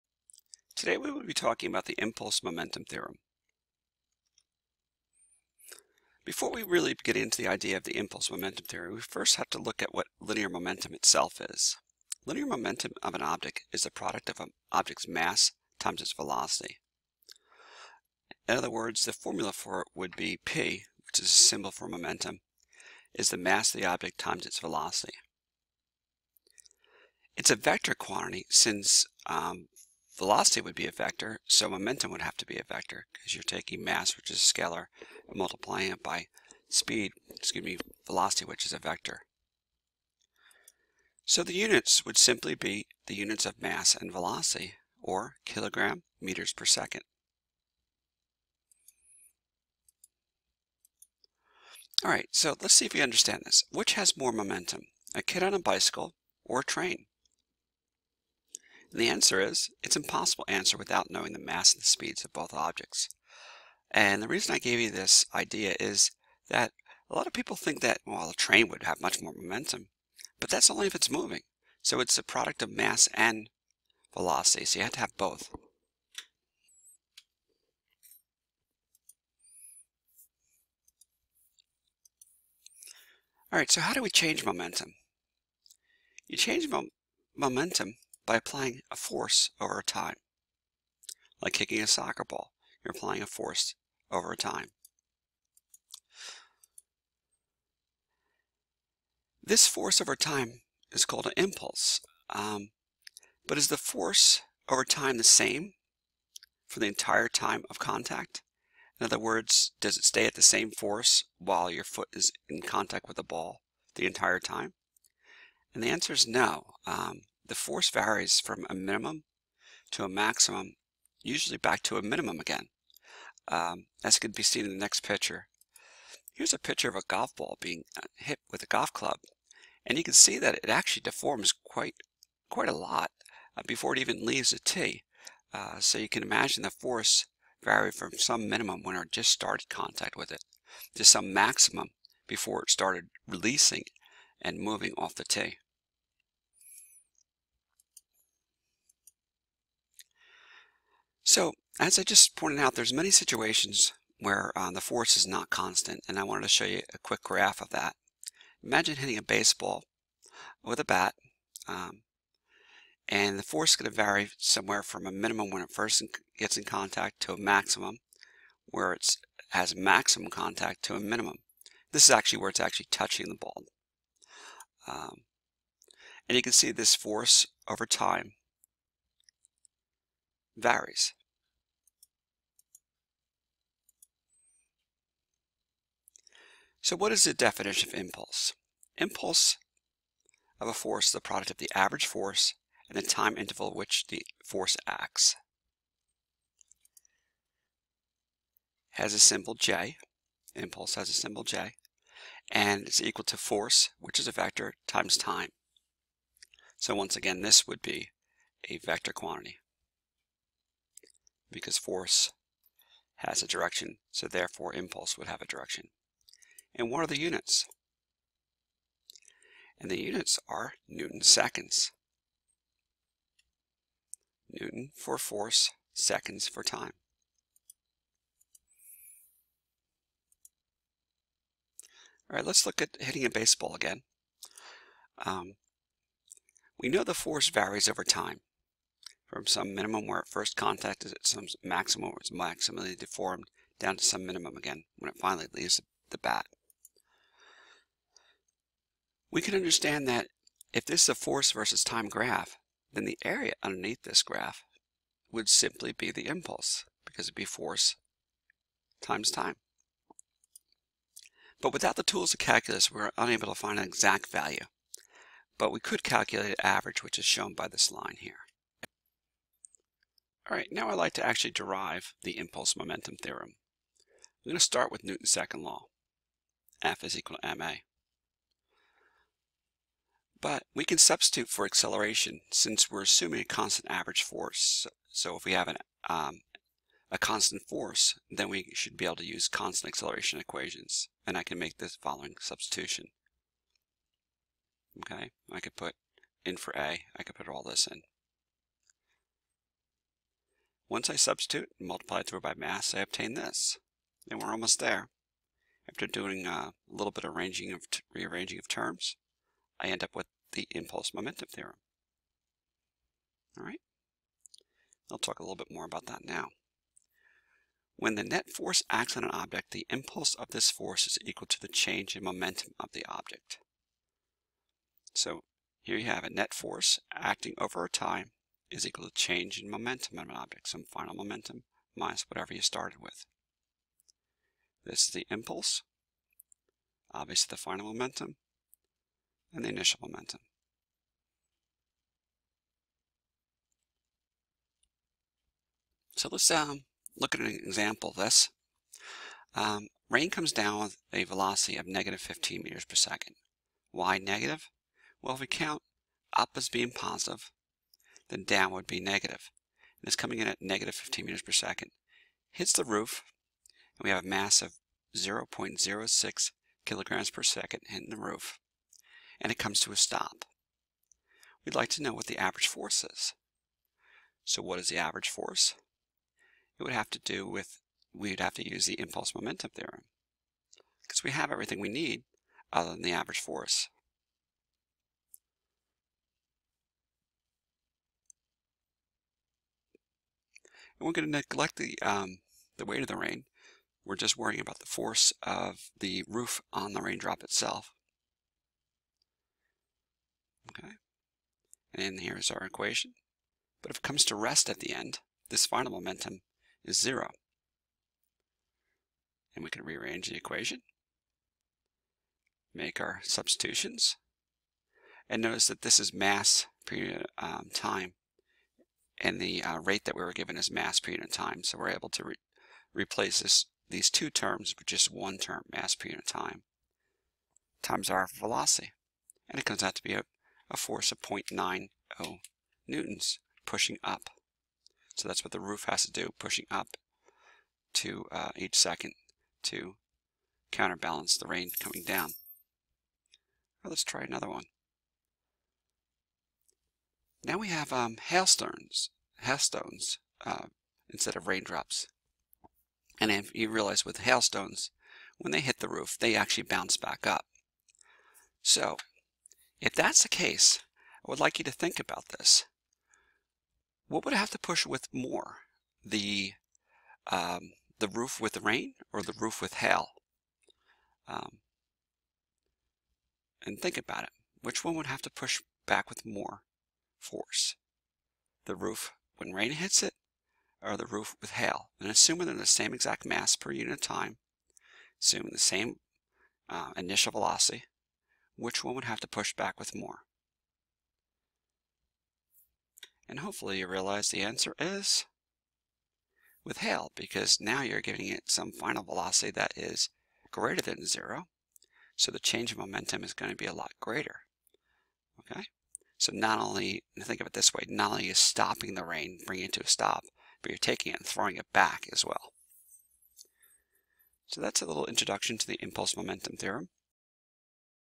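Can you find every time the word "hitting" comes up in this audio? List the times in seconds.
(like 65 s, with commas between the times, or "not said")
158 s, 232 s, 367 s.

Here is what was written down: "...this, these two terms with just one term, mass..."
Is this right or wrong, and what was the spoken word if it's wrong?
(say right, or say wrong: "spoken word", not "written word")
right.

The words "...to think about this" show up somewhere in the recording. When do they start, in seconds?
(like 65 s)
461 s.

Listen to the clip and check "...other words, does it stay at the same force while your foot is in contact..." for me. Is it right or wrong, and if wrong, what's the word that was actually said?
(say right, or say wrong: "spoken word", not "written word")
right.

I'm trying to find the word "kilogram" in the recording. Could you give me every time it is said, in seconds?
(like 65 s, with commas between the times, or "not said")
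45 s, 366 s.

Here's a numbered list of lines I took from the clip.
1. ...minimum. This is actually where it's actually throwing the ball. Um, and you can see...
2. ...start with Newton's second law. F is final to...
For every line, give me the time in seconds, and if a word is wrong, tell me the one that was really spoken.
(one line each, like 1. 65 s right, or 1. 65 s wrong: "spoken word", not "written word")
1. 170 s wrong: "touching", not "throwing"
2. 274 s wrong: "equal", not "final".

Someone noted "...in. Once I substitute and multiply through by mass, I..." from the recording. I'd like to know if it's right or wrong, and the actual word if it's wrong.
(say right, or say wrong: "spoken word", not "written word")
right.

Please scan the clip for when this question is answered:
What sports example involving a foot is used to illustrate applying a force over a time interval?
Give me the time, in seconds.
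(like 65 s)
91 s.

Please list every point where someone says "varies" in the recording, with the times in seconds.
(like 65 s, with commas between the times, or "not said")
117 s, 180 s, 237 s.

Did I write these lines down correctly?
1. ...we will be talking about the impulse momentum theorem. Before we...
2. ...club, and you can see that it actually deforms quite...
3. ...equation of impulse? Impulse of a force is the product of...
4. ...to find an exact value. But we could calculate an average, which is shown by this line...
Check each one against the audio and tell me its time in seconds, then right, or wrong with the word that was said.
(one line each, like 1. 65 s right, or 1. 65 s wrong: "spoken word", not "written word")
1. 0 s right
2. 128 s right
3. 187 s wrong: "definition", not "equation"
4. 263 s right.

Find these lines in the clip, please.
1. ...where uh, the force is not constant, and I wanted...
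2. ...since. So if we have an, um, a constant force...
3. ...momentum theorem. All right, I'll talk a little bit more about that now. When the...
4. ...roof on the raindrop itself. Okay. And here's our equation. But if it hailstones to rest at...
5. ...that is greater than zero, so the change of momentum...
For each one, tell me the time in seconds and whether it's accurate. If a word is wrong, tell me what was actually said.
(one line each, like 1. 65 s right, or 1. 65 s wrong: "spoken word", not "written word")
1. 154 s right
2. 284 s wrong: "force", not "since"
3. 311 s right
4. 396 s wrong: "comes", not "hailstones"
5. 499 s right.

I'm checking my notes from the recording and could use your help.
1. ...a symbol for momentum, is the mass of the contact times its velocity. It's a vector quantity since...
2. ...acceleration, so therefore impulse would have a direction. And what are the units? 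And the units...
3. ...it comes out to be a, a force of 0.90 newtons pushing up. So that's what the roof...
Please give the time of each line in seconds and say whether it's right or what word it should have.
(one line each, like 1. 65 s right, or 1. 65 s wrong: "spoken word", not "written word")
1. 21 s wrong: "object", not "contact"
2. 213 s wrong: "direction", not "acceleration"
3. 429 s right.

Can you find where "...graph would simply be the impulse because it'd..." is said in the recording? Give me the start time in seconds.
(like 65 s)
254 s.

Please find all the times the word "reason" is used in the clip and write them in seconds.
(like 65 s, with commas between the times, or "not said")
64 s.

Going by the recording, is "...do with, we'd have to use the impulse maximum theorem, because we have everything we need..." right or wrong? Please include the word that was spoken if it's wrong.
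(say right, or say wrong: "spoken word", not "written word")
wrong: "momentum", not "maximum".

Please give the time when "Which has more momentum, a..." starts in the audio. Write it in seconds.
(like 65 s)
53 s.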